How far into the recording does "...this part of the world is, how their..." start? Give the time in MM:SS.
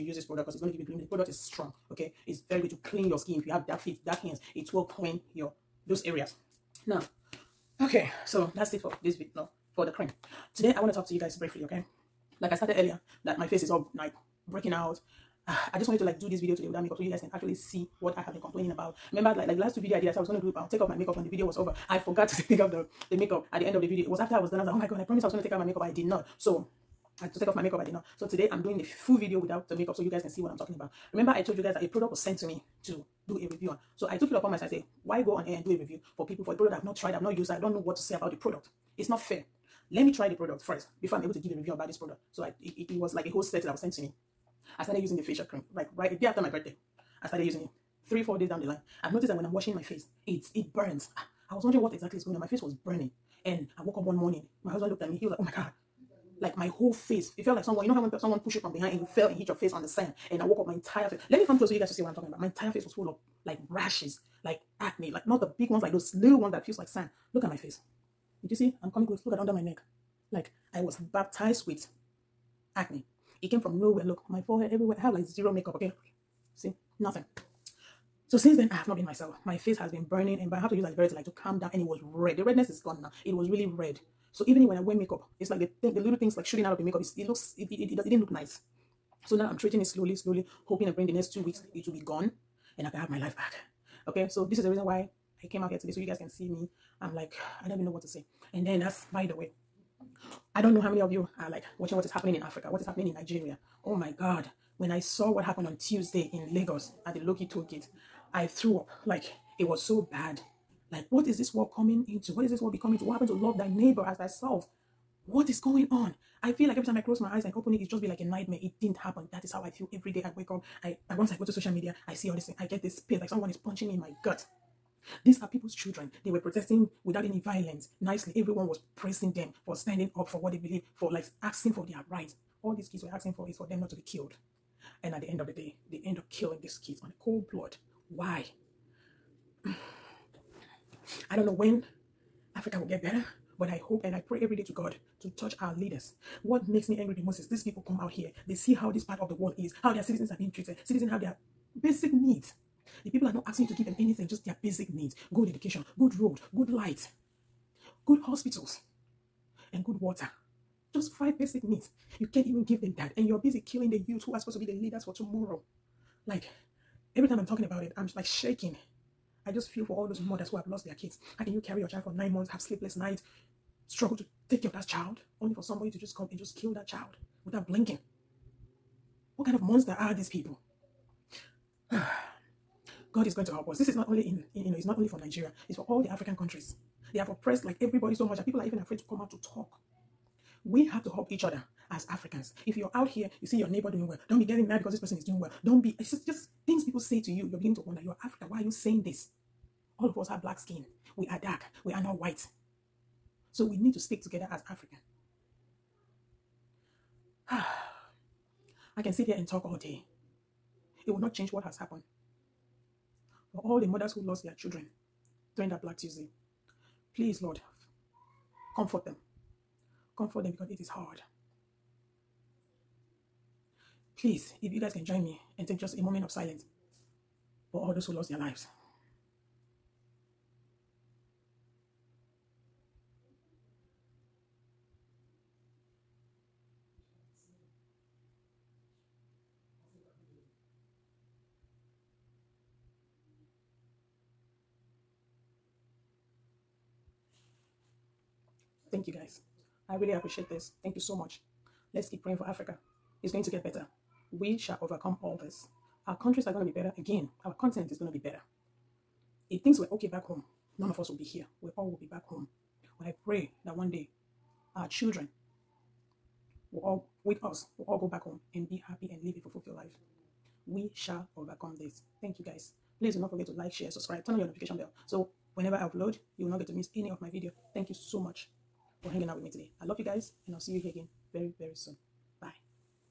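02:28.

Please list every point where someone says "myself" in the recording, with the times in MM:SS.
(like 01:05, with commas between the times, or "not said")
00:34, 01:19.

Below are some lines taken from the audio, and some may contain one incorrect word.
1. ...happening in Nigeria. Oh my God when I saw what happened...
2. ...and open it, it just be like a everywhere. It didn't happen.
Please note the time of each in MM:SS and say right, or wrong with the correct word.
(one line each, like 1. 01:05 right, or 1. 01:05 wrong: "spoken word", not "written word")
1. 01:42 right
2. 01:57 wrong: "nightmare", not "everywhere".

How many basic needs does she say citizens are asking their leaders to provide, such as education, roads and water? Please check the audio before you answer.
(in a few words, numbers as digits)
5.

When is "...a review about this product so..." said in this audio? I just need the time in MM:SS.
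00:41.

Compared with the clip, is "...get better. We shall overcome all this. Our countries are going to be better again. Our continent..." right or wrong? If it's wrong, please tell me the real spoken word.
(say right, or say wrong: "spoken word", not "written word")
right.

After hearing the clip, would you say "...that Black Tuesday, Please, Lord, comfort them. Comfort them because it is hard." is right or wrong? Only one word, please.
right.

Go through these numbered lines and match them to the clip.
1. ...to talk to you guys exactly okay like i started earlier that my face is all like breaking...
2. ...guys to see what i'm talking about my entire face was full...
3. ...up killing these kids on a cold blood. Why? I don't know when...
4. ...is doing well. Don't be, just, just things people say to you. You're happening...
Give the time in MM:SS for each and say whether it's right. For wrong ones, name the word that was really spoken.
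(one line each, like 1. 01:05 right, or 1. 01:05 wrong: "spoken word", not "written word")
1. 00:10 wrong: "briefly", not "exactly"
2. 01:01 right
3. 02:16 right
4. 03:15 wrong: "beginning", not "happening".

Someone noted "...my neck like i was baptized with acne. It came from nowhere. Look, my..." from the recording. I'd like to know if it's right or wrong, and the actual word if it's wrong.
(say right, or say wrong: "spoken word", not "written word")
right.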